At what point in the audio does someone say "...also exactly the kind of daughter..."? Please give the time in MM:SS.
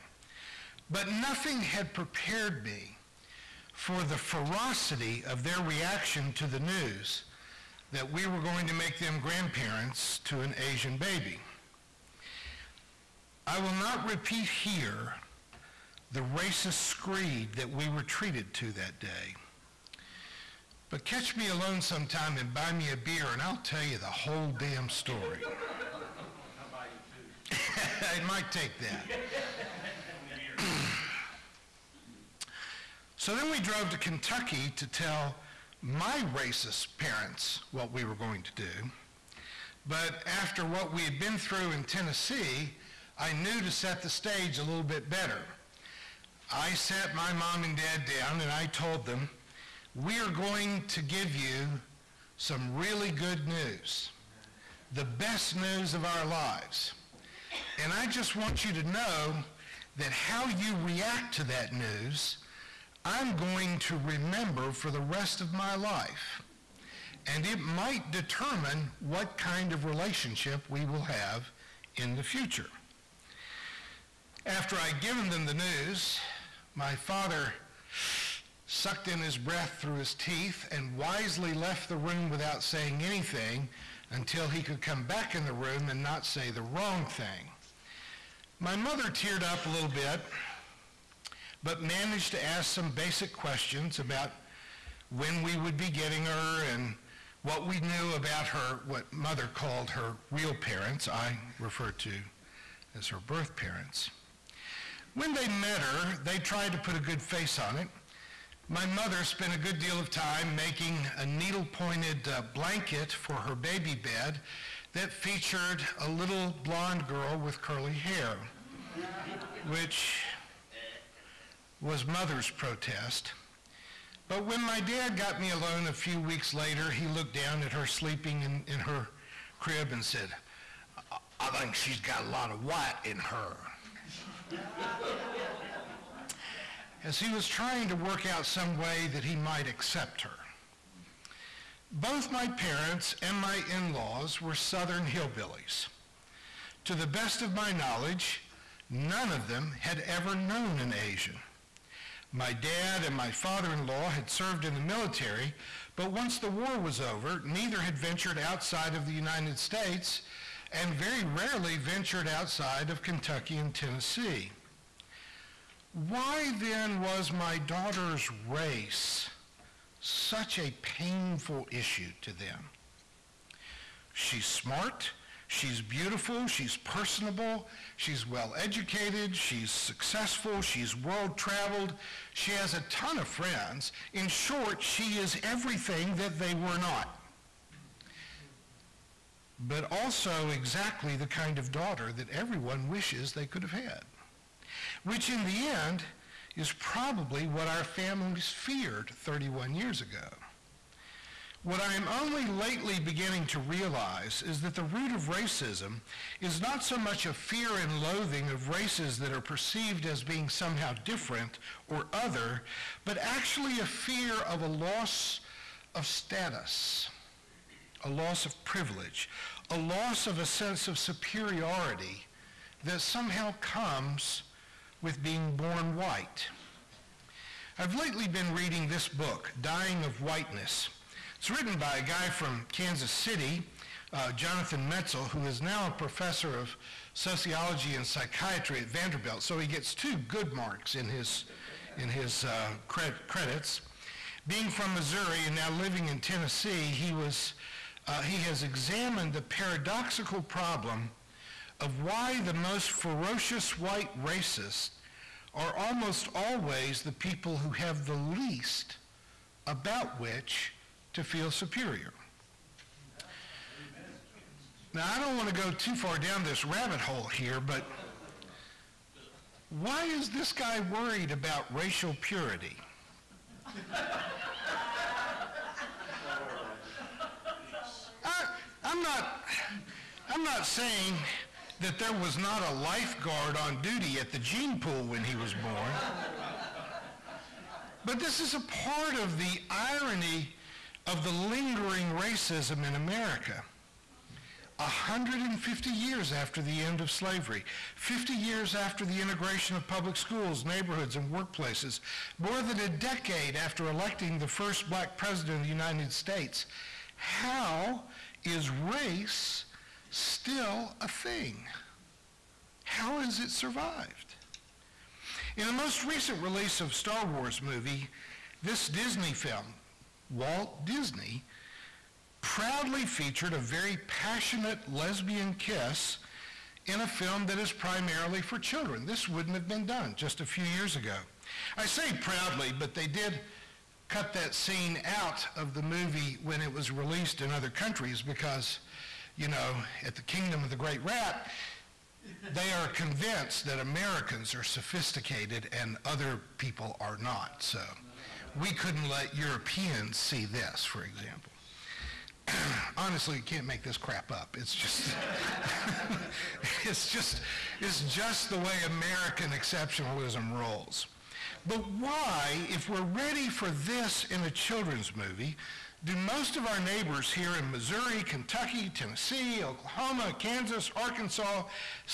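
03:09.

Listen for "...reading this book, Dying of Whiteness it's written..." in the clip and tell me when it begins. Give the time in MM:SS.
03:48.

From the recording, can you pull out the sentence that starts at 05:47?
So we couldn't let Europeans see this, for example.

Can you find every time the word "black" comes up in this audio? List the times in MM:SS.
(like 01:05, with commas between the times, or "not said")
05:04.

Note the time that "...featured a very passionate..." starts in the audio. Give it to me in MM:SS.
05:23.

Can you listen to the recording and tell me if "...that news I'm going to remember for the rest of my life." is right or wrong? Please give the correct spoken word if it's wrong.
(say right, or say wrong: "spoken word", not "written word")
right.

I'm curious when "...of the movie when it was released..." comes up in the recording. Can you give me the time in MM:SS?
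05:35.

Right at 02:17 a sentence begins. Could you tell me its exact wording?
As he was trying to work out some way that he might accept her.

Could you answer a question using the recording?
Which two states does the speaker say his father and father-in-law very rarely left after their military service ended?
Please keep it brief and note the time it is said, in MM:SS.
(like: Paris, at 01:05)
Kentucky and Tennessee, at 02:43.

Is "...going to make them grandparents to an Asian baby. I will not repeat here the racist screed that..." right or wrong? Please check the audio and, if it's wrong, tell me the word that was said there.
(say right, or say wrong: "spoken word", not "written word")
right.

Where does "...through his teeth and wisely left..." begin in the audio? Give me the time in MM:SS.
01:19.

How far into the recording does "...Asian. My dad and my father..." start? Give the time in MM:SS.
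02:30.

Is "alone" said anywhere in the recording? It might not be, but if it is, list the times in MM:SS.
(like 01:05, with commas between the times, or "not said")
00:21, 02:05.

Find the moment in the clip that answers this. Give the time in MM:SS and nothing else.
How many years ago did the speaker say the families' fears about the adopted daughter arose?
03:19.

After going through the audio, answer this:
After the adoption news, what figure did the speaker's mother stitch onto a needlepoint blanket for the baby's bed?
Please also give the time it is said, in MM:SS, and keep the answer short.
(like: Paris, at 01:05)
little blonde girl, at 01:56.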